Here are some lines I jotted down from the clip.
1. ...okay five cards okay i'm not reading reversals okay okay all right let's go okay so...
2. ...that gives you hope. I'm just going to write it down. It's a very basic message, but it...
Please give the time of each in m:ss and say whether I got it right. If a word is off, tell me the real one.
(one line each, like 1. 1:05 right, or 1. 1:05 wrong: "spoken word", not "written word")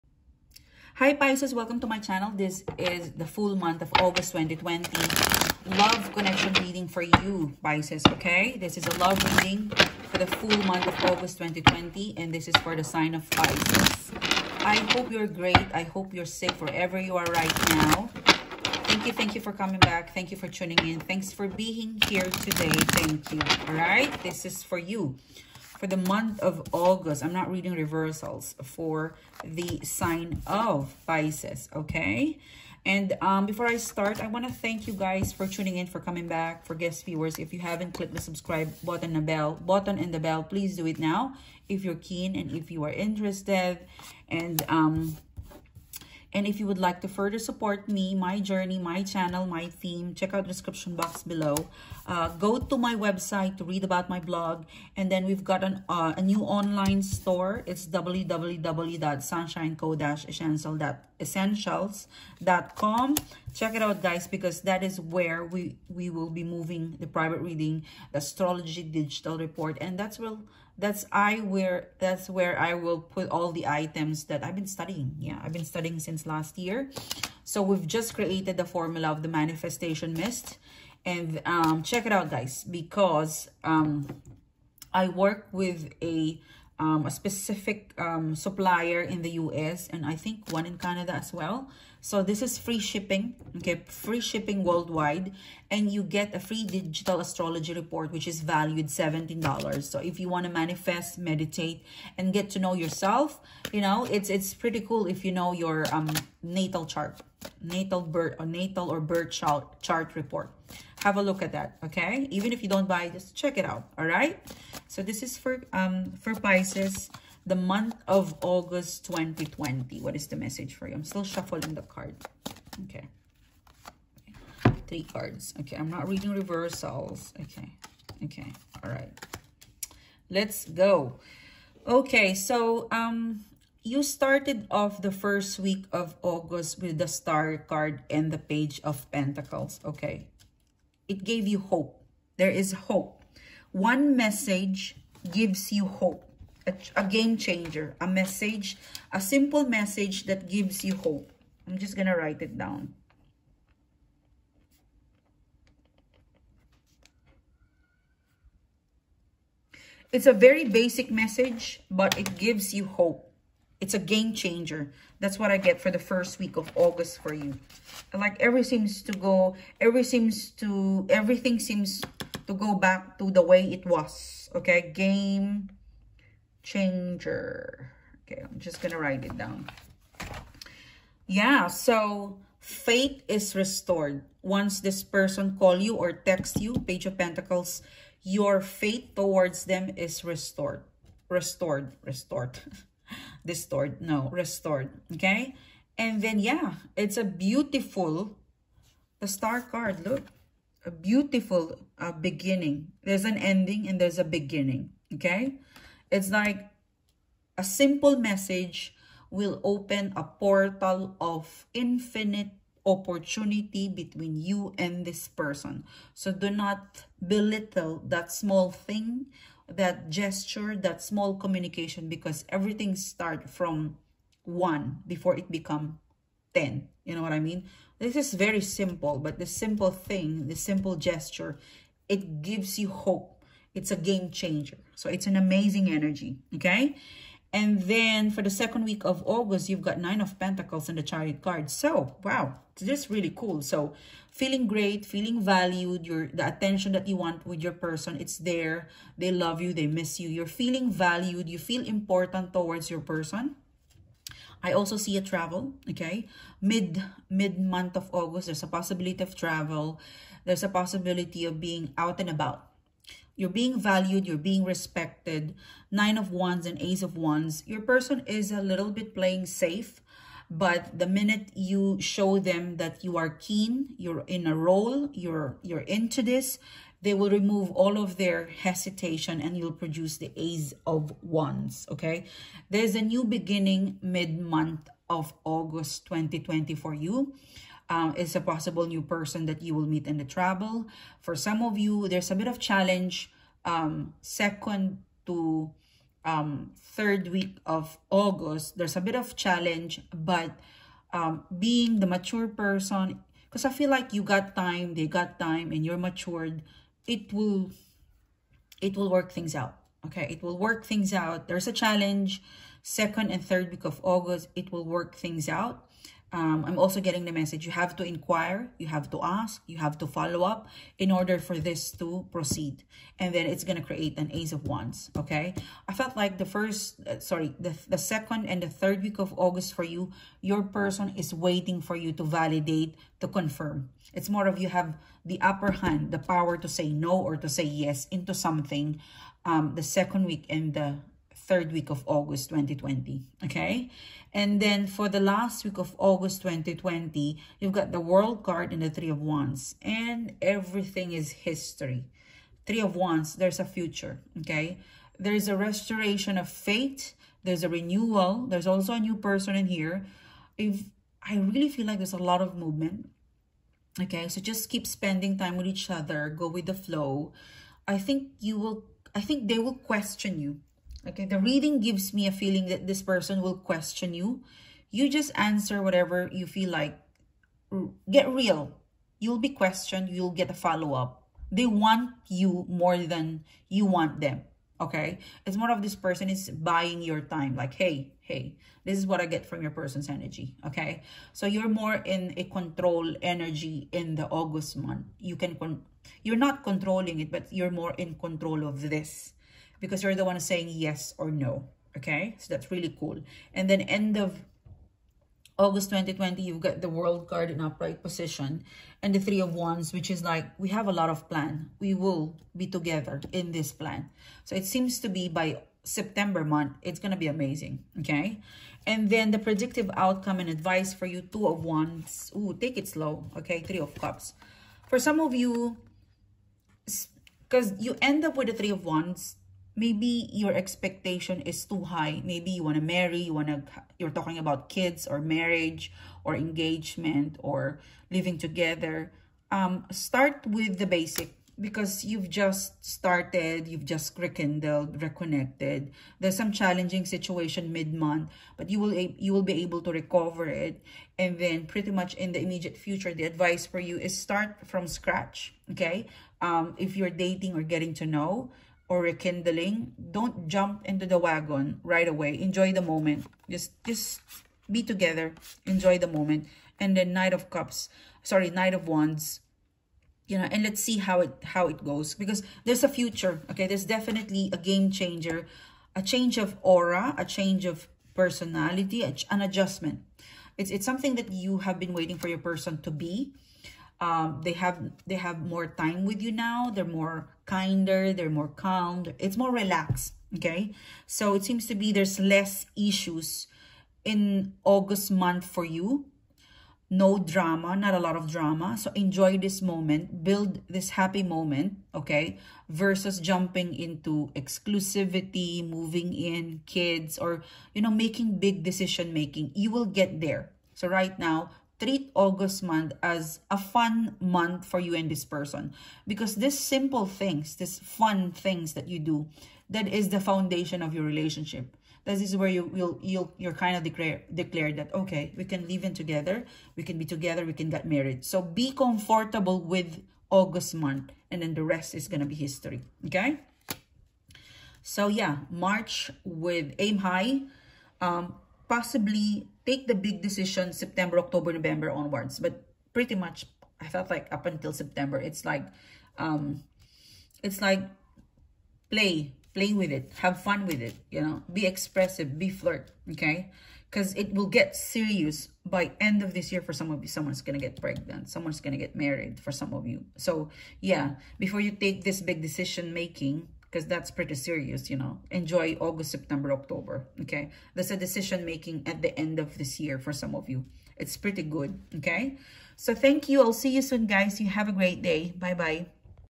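1. 2:02 wrong: "three", not "five"
2. 2:30 right.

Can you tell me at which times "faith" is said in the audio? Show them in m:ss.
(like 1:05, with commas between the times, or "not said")
3:02, 3:08.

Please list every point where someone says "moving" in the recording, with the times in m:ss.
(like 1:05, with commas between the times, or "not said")
1:06, 8:25.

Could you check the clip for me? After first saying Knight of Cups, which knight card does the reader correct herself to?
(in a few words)
Knight of Wands.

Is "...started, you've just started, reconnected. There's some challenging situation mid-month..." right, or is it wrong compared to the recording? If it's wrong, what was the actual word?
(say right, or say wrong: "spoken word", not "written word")
wrong: "rekindled", not "started".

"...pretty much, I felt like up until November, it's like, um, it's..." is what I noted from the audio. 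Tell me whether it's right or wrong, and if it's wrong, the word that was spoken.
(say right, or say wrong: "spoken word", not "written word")
wrong: "September", not "November".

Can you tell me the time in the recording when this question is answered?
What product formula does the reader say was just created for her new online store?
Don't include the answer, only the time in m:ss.
1:19.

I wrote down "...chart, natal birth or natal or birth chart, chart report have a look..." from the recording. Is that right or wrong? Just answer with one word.
right.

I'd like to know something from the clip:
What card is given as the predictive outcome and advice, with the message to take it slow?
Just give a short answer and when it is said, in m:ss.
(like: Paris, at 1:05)
Two of Wands, at 7:01.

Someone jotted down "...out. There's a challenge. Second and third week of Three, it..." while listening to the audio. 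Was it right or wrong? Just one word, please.
wrong.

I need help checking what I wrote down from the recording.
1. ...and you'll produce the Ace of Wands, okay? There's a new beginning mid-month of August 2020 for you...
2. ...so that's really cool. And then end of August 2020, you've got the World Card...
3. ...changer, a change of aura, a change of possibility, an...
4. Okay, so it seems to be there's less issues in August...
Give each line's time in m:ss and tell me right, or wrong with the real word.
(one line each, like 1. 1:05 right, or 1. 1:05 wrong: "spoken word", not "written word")
1. 4:39 right
2. 6:42 right
3. 7:54 wrong: "personality", not "possibility"
4. 8:10 right.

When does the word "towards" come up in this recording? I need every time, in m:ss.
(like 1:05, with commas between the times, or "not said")
3:09, 4:12.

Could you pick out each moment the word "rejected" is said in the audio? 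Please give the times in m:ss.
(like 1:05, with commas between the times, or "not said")
not said.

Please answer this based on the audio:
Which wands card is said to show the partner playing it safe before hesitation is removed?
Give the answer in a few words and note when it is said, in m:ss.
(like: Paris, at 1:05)
Nine of Wands, at 4:25.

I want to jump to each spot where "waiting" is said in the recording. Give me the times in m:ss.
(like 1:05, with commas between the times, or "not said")
5:31, 8:01.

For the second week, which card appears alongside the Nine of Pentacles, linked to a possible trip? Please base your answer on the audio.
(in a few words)
The Chariot.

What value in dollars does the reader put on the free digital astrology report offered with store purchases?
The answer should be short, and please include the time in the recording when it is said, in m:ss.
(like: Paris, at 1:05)
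$17, at 1:38.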